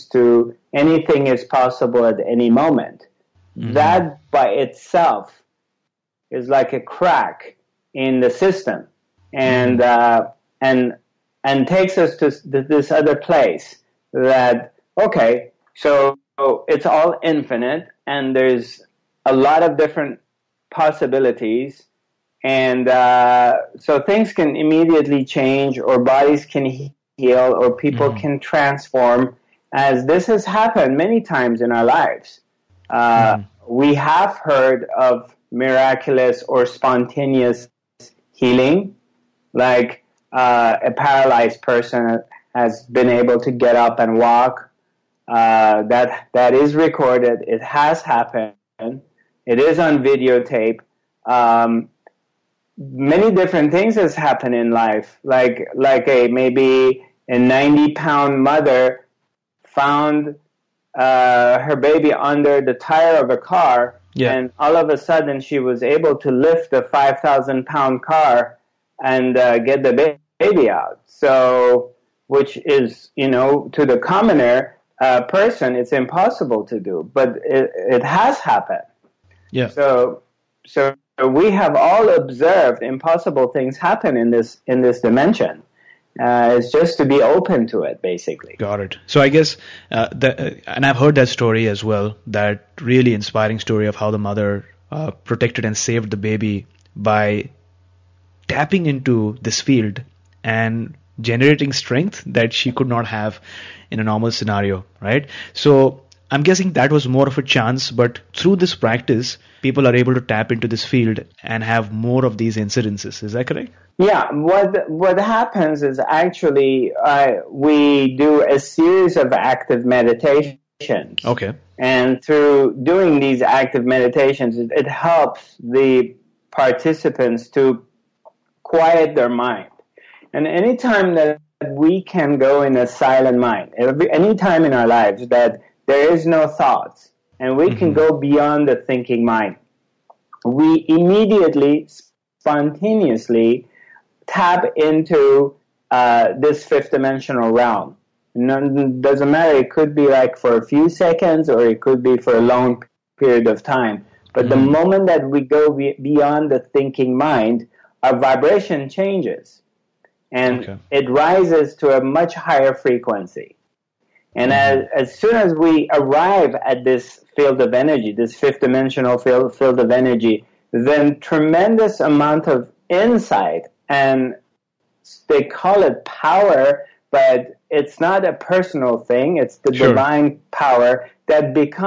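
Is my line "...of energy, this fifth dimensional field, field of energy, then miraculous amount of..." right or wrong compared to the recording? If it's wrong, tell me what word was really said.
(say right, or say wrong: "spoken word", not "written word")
wrong: "tremendous", not "miraculous".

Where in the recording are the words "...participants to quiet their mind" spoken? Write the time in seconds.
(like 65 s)
126 s.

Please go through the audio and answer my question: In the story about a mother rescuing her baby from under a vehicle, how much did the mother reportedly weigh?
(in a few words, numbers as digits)
90 pounds.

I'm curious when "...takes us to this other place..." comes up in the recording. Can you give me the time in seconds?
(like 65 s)
11 s.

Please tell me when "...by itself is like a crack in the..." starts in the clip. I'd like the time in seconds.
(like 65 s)
4 s.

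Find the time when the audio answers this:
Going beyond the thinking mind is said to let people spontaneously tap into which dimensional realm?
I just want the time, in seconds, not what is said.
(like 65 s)
146 s.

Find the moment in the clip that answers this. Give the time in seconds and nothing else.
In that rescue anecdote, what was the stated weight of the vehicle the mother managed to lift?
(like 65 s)
66 s.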